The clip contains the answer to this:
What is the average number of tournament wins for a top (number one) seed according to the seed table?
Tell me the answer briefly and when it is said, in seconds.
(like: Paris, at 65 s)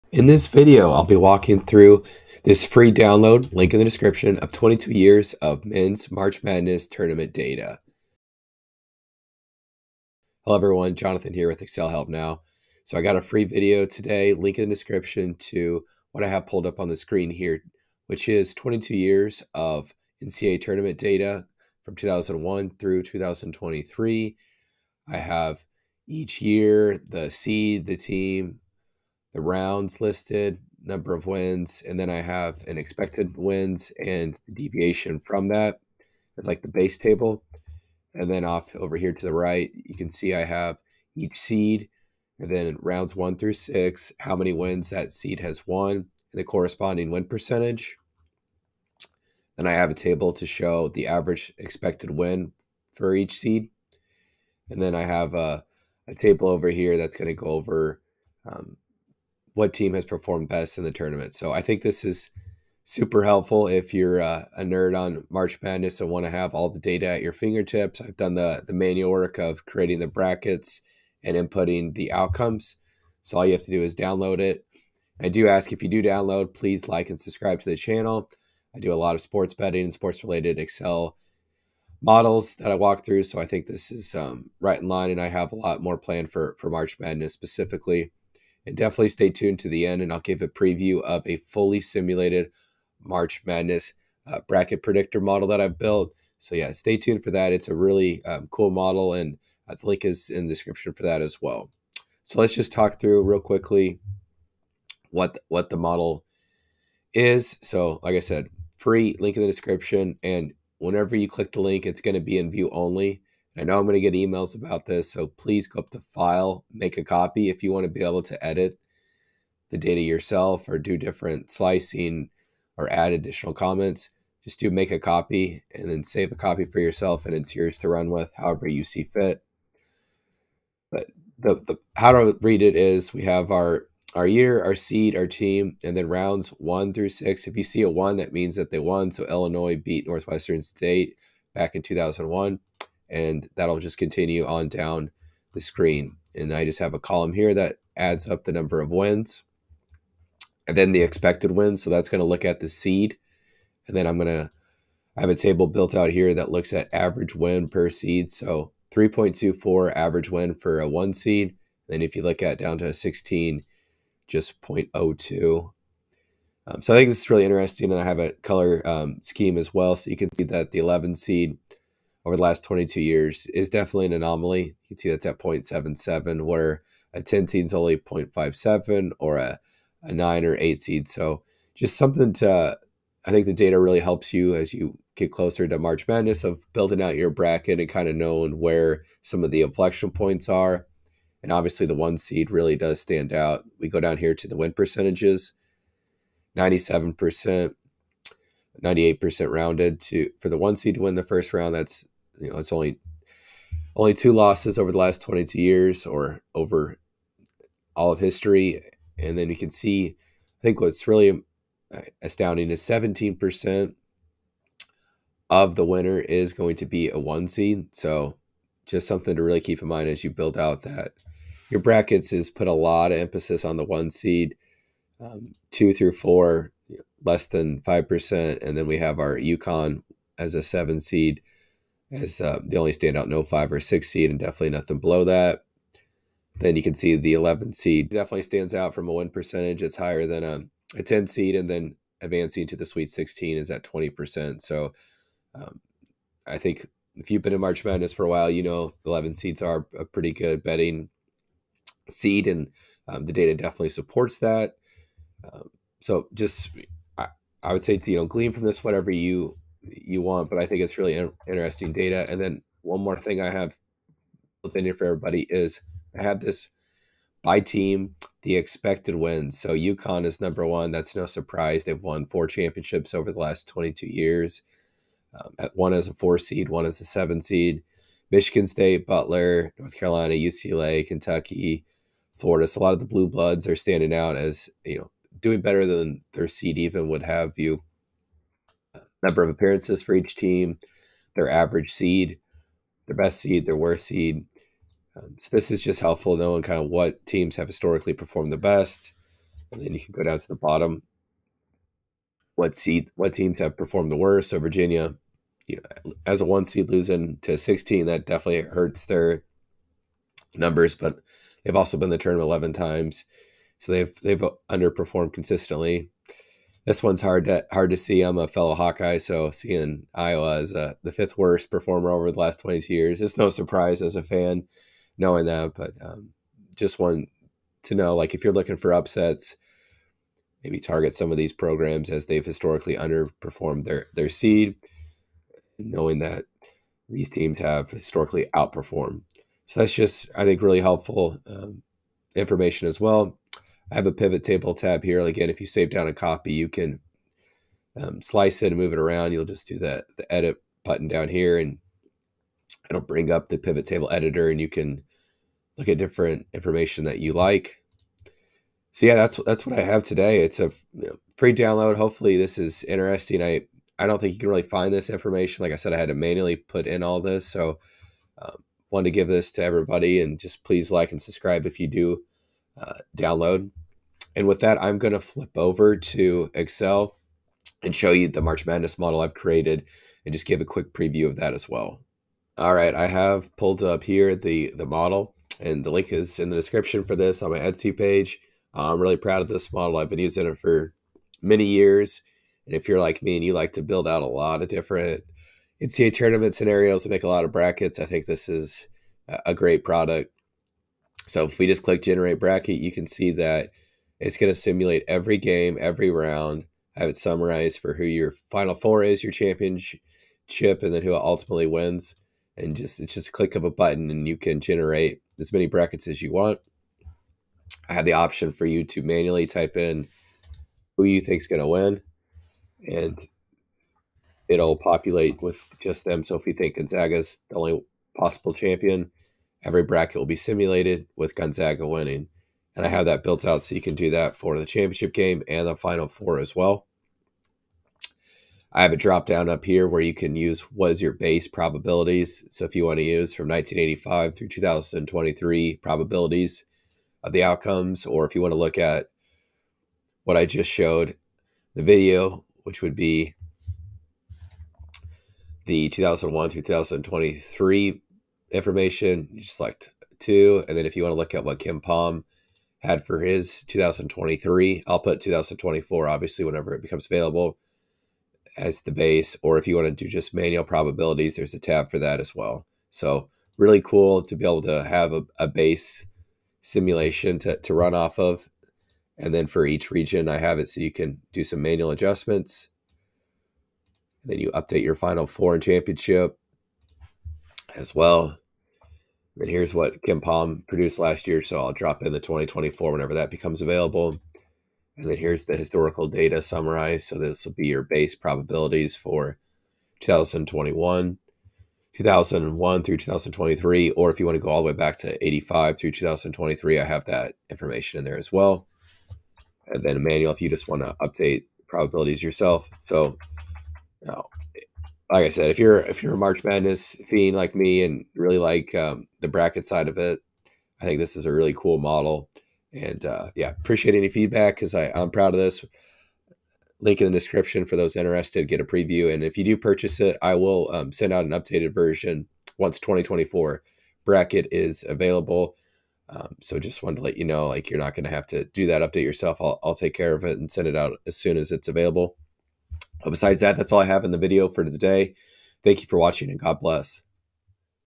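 3.24, at 158 s.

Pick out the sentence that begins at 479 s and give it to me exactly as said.
And then for each region, I have it so you can do some manual adjustments.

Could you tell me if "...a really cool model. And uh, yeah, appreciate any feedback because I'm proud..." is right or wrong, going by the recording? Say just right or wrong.
right.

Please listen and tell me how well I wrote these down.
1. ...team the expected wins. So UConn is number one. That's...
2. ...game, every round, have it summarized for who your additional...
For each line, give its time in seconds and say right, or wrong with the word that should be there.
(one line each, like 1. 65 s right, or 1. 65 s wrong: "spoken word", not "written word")
1. 267 s right
2. 405 s wrong: "final", not "additional".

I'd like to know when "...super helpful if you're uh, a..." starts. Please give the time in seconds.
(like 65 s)
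62 s.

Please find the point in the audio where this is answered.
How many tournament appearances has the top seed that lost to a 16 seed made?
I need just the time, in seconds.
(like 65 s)
312 s.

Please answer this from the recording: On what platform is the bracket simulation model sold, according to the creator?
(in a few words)
Etsy.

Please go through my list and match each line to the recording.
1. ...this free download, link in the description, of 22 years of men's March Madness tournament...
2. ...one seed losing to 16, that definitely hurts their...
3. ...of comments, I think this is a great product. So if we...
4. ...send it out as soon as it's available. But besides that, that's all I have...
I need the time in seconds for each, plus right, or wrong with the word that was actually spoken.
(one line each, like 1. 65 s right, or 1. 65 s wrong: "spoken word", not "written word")
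1. 2 s right
2. 306 s right
3. 397 s wrong: "brackets", not "comments"
4. 540 s right.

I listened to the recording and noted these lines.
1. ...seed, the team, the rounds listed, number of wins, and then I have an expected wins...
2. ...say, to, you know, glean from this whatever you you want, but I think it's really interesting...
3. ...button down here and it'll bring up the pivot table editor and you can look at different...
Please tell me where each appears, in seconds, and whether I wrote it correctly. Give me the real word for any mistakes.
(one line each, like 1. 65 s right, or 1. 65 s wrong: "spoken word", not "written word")
1. 27 s right
2. 257 s right
3. 350 s right.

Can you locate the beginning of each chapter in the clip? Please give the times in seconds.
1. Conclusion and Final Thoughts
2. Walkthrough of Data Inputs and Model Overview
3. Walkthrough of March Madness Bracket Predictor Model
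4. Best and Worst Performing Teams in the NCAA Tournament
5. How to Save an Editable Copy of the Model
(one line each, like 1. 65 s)
1. 515 s
2. 130 s
3. 382 s
4. 262 s
5. 110 s.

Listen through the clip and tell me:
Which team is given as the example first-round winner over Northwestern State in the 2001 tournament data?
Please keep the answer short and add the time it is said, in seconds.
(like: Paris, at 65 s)
Illinois, at 139 s.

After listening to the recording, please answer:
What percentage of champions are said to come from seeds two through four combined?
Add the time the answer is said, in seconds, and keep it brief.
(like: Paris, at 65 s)
Less than 5%, at 227 s.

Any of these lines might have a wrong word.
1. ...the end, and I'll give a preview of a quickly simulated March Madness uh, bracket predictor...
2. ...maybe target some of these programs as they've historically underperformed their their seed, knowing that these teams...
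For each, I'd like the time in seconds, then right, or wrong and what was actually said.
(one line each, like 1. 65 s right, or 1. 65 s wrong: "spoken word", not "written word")
1. 89 s wrong: "fully", not "quickly"
2. 330 s right.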